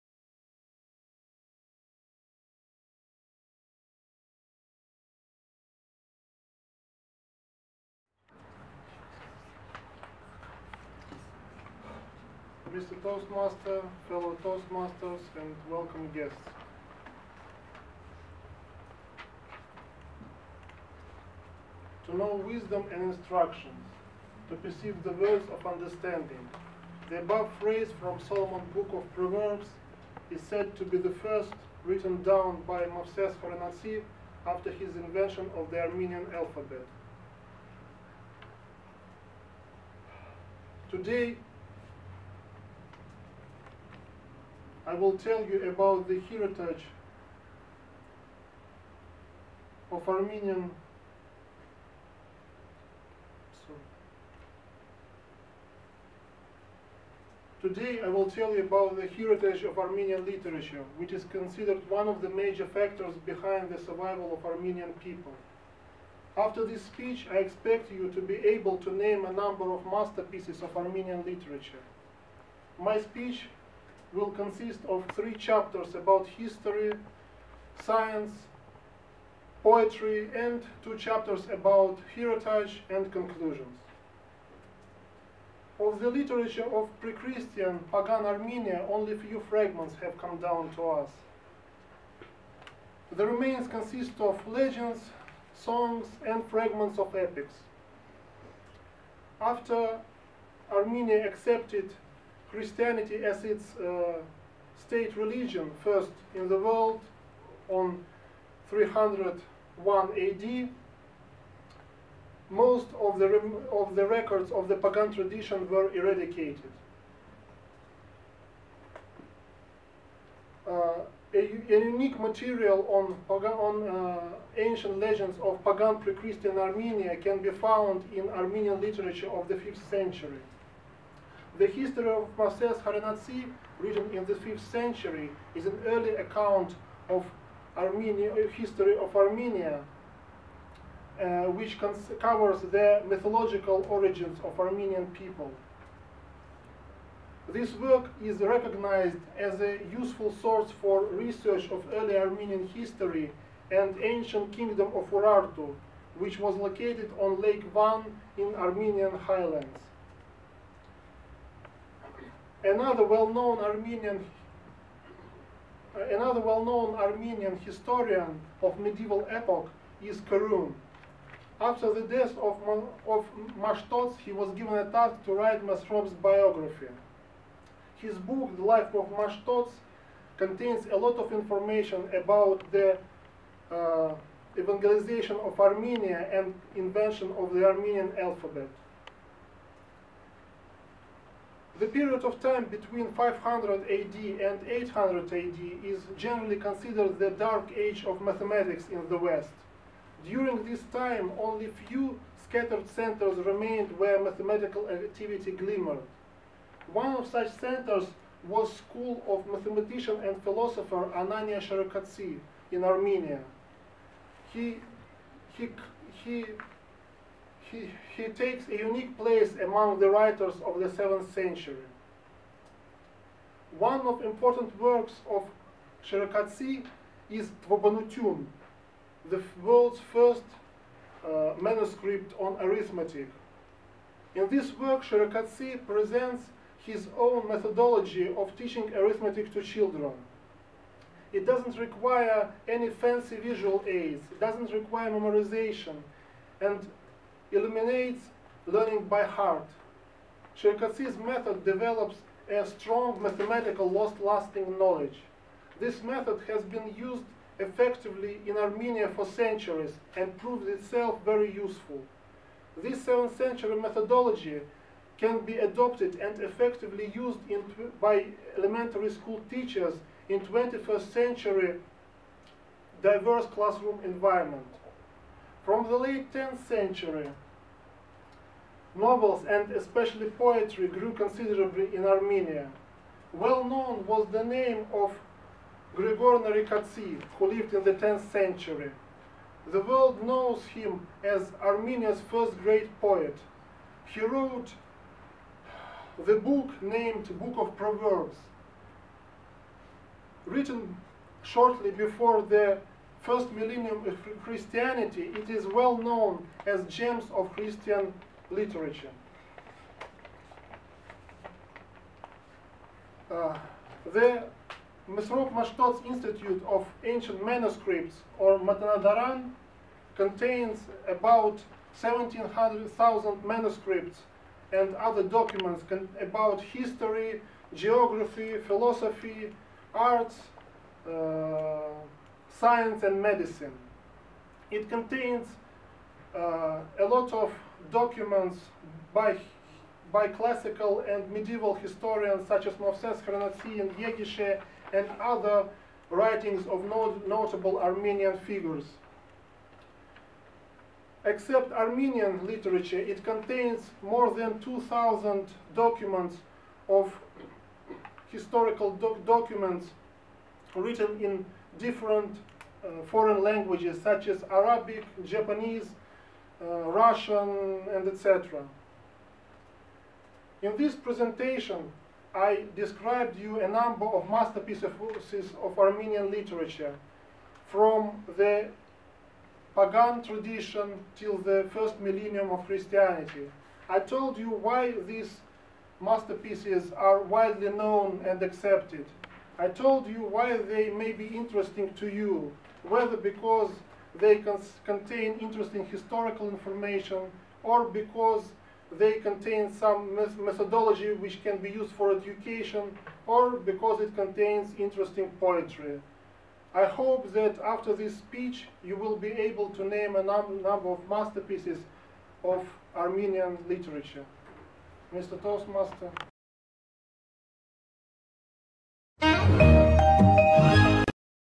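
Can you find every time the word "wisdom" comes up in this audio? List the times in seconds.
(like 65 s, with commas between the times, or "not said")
22 s.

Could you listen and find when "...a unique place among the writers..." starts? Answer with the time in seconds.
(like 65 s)
218 s.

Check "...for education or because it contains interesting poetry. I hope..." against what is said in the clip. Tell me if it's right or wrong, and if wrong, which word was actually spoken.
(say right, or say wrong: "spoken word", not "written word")
right.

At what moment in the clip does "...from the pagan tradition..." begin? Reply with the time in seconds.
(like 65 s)
377 s.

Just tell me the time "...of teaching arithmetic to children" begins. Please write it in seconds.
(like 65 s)
238 s.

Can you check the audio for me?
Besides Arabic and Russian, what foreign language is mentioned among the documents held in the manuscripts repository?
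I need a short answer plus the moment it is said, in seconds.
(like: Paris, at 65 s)
Japanese, at 365 s.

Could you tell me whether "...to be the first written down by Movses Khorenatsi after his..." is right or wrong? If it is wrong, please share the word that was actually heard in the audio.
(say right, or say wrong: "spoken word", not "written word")
right.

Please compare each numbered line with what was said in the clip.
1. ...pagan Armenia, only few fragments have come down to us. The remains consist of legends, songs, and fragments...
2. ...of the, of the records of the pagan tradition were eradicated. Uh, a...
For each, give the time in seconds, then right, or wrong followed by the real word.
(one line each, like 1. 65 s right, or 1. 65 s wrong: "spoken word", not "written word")
1. 87 s right
2. 112 s right.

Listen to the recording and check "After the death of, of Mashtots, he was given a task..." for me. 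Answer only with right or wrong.
right.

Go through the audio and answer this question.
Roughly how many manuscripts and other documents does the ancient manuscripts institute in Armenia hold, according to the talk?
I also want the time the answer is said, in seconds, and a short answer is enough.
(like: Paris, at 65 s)
17,000, at 321 s.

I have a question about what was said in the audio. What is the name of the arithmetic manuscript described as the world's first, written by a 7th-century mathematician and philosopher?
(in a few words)
Tvabanutyun.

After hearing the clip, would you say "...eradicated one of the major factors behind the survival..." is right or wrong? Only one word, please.
wrong.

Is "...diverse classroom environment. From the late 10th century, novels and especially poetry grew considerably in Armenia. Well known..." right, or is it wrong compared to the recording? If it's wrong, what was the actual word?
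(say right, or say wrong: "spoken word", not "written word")
right.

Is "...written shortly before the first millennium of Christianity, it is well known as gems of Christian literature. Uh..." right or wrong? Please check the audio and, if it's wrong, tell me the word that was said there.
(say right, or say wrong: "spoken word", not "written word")
right.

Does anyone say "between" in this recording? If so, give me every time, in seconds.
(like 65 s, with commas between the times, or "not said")
192 s.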